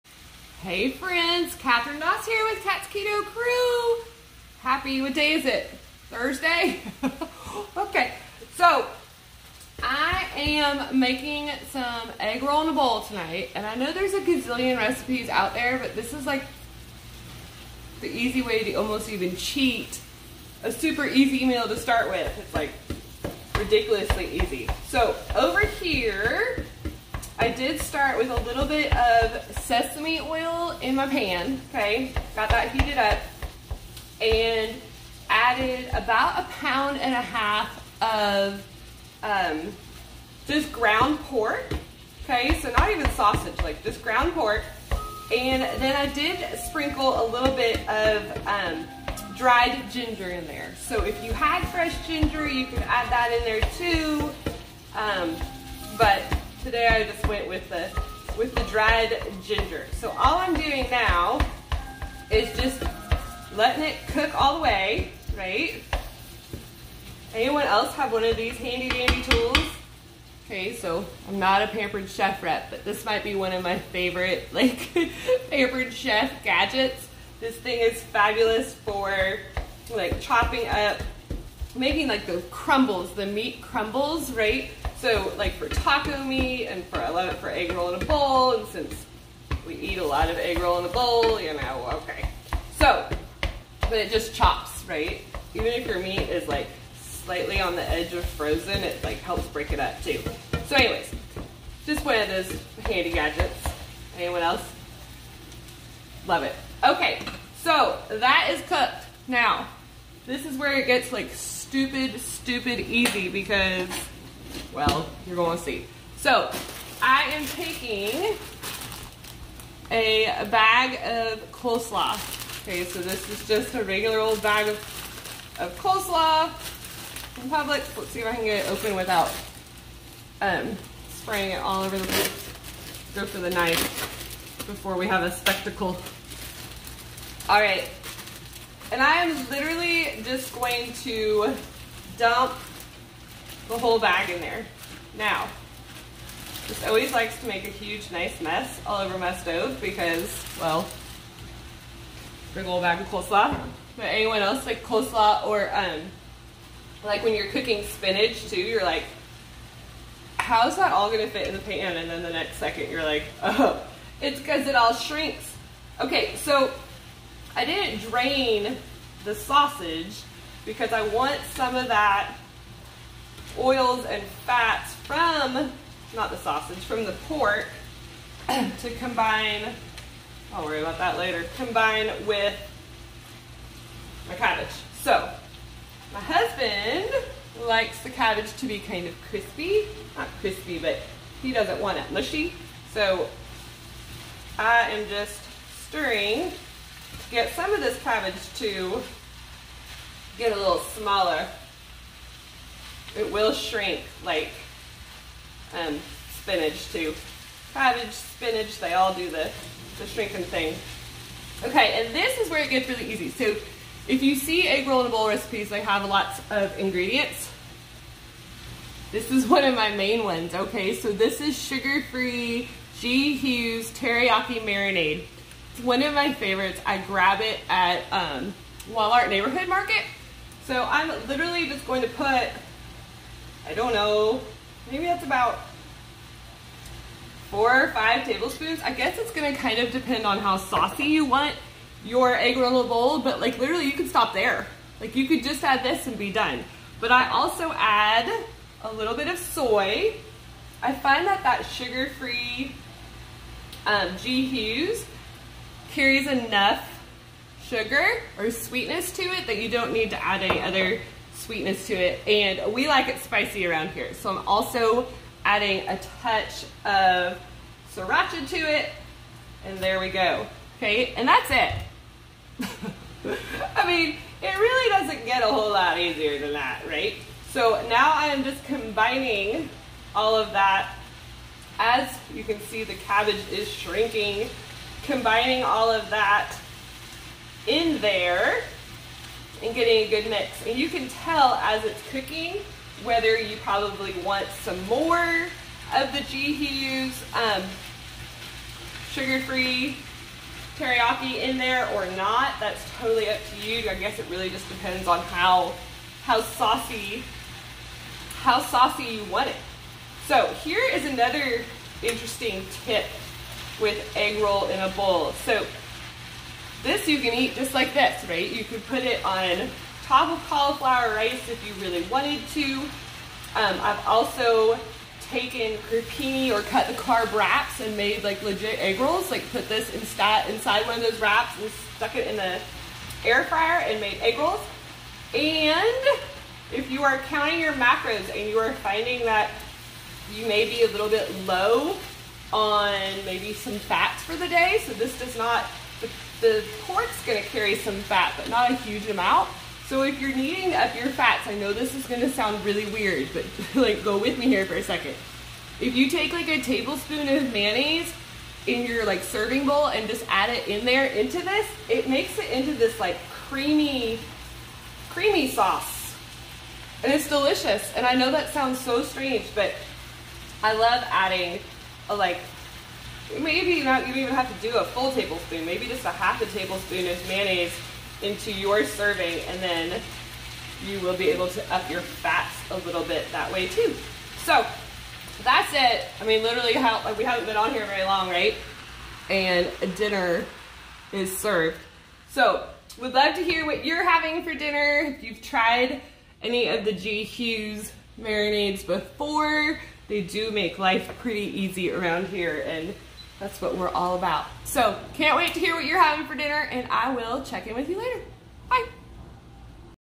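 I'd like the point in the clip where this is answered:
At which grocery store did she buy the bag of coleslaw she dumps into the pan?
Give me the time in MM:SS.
02:07.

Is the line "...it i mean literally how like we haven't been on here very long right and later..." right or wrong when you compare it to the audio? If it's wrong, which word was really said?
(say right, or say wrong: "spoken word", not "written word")
wrong: "dinner", not "later".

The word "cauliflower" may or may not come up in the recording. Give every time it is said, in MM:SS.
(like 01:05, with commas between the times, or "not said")
05:20.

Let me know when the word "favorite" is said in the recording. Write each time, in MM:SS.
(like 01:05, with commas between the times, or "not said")
01:13, 03:46.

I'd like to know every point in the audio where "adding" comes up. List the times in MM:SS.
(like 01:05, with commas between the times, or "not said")
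04:25, 06:11.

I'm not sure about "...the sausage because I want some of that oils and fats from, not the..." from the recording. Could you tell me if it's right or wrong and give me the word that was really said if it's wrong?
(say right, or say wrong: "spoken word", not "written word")
right.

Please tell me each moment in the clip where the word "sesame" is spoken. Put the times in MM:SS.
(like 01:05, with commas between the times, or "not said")
00:29.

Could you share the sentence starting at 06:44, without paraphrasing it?
So can't wait to hear what you're having for dinner and I will check in with you later.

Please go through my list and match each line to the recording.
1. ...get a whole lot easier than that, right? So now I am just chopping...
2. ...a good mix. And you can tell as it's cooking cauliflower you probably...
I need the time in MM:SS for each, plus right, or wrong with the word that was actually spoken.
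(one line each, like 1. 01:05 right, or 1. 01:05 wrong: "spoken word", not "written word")
1. 04:35 wrong: "combining", not "chopping"
2. 04:50 wrong: "whether", not "cauliflower".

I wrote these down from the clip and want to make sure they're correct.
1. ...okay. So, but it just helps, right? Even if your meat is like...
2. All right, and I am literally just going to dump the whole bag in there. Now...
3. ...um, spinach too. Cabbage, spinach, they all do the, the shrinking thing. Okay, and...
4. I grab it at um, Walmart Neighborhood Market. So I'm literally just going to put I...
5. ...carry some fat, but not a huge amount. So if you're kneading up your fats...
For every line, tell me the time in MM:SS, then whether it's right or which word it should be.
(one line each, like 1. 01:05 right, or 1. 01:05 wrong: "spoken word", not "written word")
1. 01:32 wrong: "chops", not "helps"
2. 02:17 right
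3. 03:25 right
4. 03:46 right
5. 05:47 right.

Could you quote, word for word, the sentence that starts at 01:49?
Now, this is where it gets like stupid, stupid easy because well, you're going to see.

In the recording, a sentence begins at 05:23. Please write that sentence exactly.
Um, I've also taken Crepini or cut the carb wraps and made like legit egg rolls.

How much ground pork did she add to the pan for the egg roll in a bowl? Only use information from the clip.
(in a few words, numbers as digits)
a pound and a half.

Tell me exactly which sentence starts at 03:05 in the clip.
So, my husband likes the cabbage to be kind of crispy, not crispy, but he doesn't want it mushy.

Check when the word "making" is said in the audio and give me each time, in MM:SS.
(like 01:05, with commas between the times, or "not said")
00:10, 01:21.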